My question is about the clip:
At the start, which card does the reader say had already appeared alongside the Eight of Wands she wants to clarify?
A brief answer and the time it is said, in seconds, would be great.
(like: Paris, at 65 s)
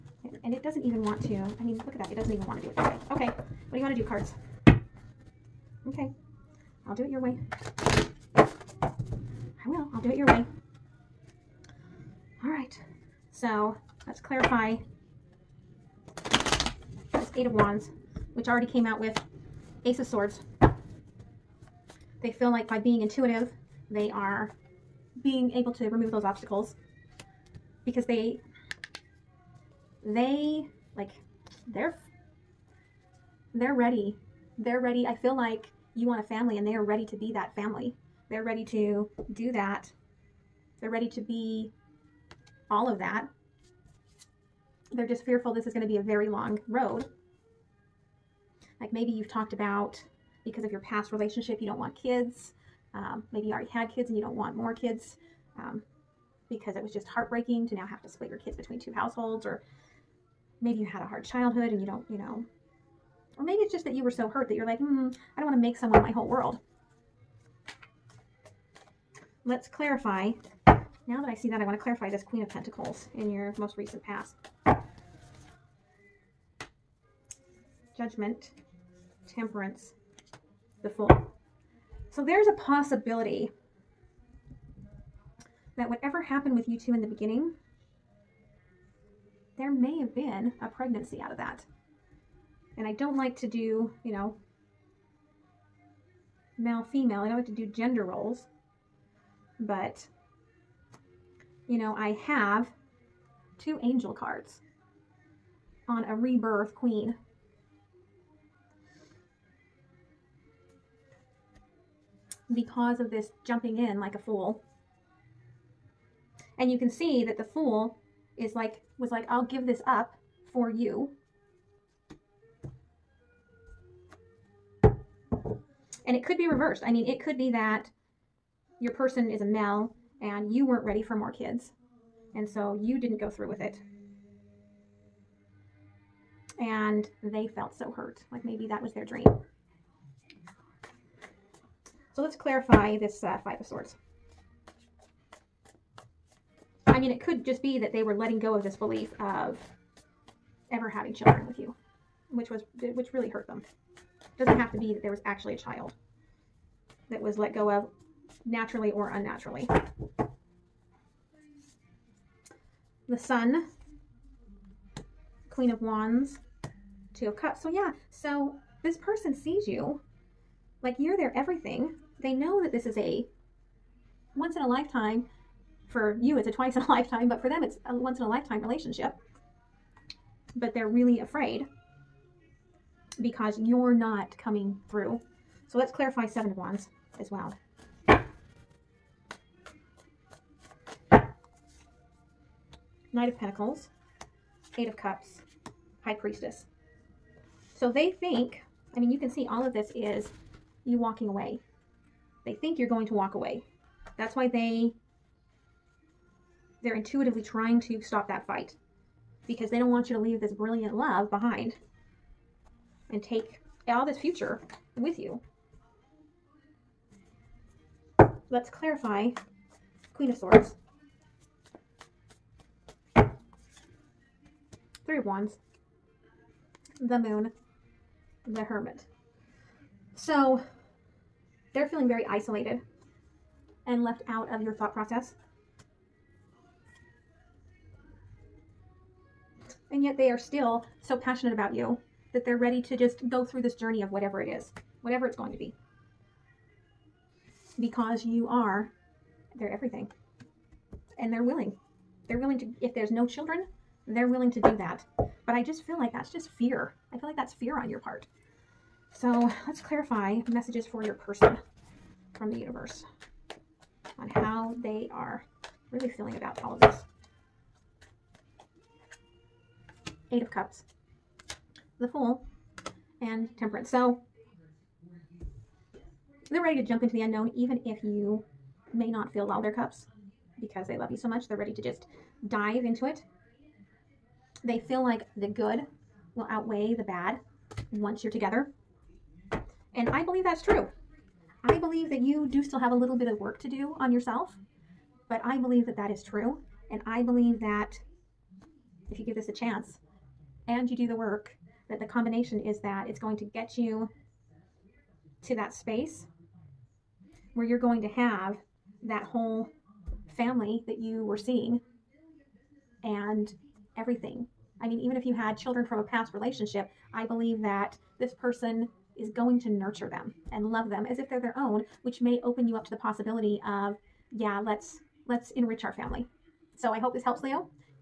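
Ace of Swords, at 19 s.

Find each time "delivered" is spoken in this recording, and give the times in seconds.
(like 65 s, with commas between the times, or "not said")
not said.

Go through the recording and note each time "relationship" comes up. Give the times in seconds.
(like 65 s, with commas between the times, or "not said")
51 s, 178 s, 316 s.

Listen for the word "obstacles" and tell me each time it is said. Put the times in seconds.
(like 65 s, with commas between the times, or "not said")
26 s.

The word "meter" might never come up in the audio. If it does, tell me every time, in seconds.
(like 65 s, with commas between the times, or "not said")
not said.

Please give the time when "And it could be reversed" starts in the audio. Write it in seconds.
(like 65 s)
126 s.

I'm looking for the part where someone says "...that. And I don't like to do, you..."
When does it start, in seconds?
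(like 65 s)
91 s.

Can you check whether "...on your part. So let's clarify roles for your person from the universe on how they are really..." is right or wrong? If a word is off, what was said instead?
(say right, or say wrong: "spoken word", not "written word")
wrong: "messages", not "roles".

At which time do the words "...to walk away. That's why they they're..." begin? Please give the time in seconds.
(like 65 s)
203 s.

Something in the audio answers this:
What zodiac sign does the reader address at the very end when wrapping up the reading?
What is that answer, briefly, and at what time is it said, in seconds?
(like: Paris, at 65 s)
Leo, at 327 s.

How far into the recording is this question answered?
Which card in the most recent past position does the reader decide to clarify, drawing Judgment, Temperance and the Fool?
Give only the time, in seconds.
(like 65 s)
72 s.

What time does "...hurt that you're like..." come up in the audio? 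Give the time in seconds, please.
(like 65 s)
64 s.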